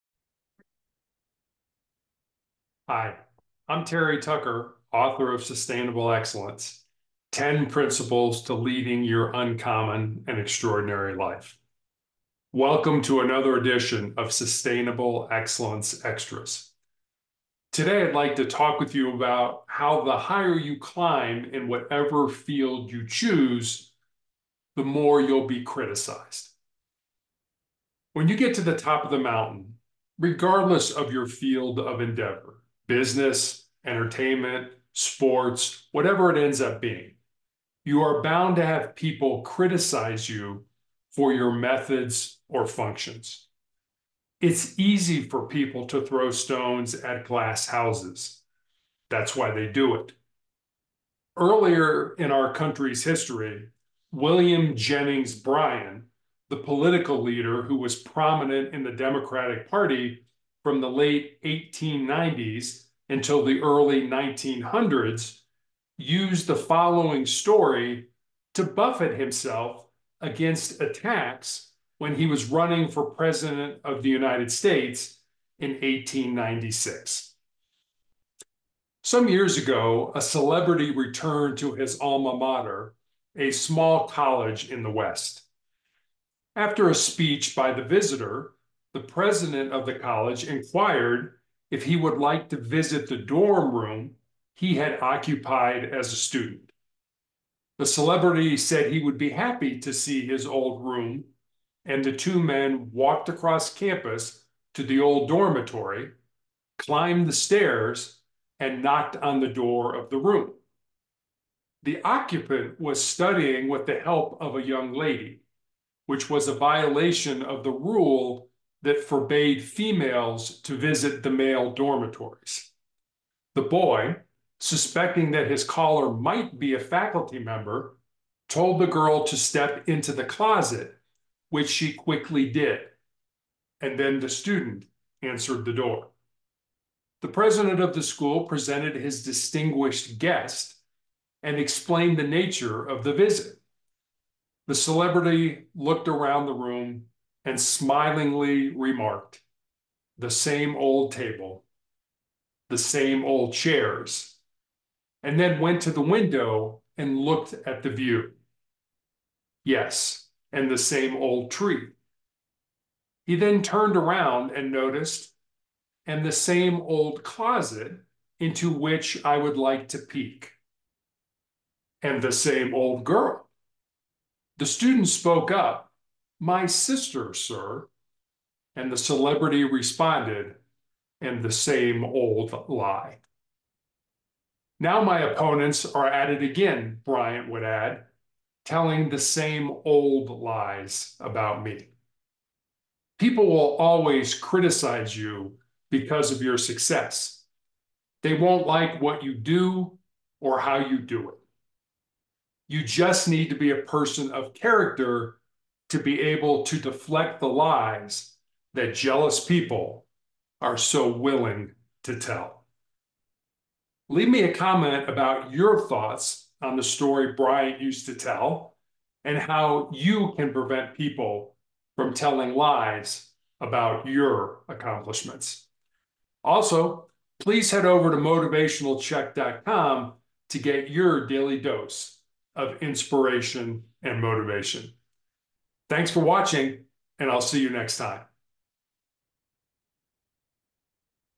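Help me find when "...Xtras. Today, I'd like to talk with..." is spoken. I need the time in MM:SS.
00:16.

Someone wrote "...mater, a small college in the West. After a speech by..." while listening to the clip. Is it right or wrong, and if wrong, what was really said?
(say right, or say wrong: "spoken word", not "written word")
right.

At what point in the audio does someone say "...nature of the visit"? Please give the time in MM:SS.
02:22.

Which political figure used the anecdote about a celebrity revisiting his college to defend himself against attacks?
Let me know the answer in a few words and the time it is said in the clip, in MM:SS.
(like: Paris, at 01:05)
William Jennings Bryan, at 00:54.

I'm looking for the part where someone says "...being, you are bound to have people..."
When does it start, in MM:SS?
00:36.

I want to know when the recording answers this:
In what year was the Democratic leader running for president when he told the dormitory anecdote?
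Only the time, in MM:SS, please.
01:15.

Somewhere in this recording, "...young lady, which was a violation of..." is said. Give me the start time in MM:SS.
01:54.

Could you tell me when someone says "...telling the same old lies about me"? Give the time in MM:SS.
03:08.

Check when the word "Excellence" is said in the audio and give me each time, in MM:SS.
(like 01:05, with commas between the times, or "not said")
00:06, 00:15.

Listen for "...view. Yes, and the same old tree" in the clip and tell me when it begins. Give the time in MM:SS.
02:37.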